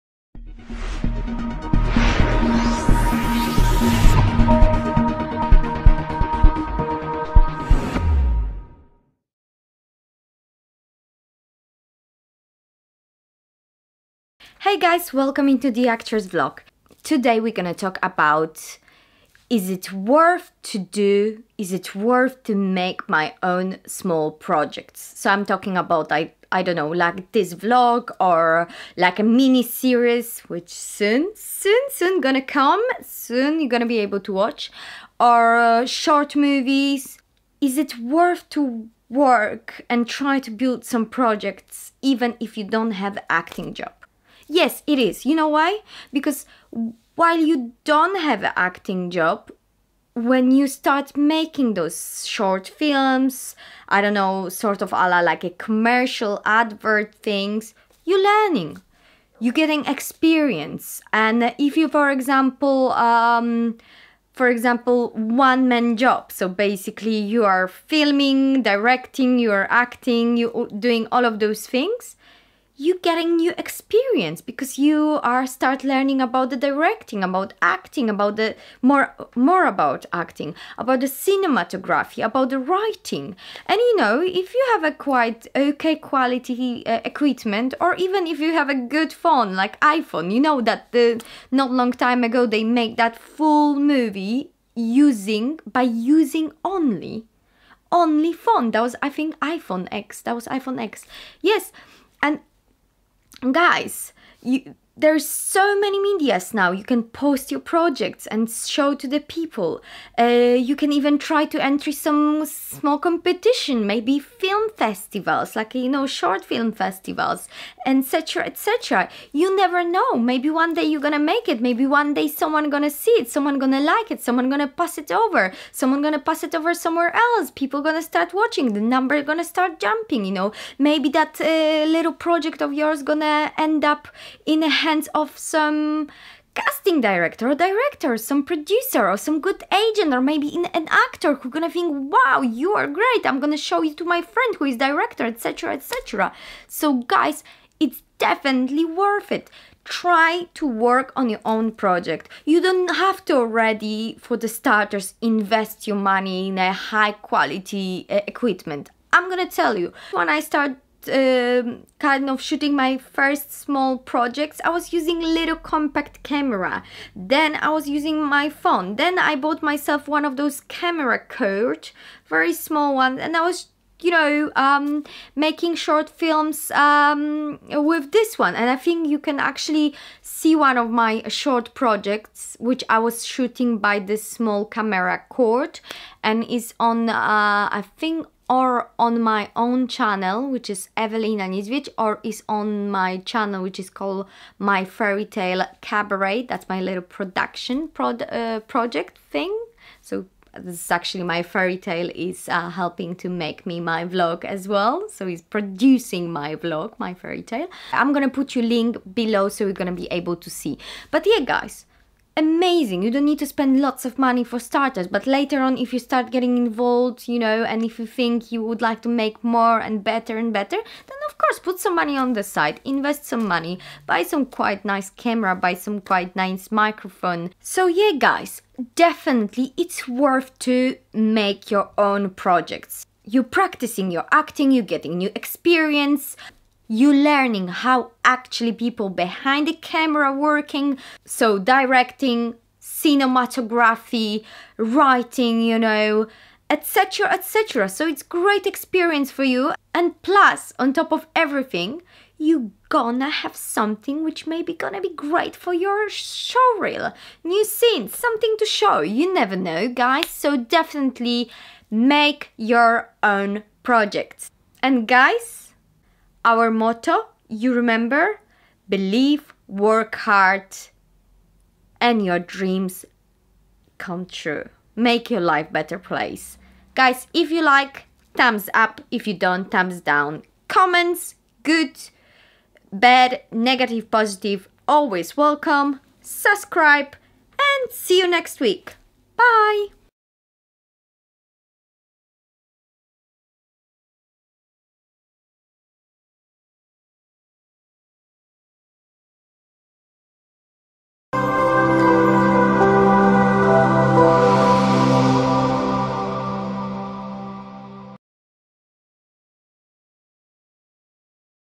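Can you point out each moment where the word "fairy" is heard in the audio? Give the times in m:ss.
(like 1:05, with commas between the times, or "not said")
3:14, 3:21, 3:27.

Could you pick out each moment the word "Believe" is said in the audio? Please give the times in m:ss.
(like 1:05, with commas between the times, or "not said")
4:28.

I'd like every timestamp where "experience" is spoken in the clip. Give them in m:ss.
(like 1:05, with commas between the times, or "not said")
0:59, 1:13, 3:55, 4:08.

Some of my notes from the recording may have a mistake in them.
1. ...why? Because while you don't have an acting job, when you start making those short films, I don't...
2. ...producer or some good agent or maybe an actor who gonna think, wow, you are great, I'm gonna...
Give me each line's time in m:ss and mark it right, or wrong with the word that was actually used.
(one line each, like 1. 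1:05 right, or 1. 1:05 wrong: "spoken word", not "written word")
1. 0:45 right
2. 2:18 right.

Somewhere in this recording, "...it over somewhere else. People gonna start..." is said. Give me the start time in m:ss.
2:06.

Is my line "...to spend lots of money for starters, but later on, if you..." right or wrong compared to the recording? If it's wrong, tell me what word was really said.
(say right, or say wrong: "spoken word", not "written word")
right.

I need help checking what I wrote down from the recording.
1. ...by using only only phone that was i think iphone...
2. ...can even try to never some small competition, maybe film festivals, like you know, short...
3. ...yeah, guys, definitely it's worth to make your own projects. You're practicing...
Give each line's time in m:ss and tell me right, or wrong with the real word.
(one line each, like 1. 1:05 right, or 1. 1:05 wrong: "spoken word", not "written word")
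1. 1:35 right
2. 1:50 wrong: "enter", not "never"
3. 3:47 right.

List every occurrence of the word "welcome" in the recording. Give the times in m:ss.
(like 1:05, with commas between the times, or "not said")
0:15, 4:45.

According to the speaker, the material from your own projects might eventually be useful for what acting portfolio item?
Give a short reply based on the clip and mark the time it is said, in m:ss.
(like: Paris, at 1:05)
show reel, at 4:16.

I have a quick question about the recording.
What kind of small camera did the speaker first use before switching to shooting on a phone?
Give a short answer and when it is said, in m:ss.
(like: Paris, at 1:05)
compact camera, at 2:45.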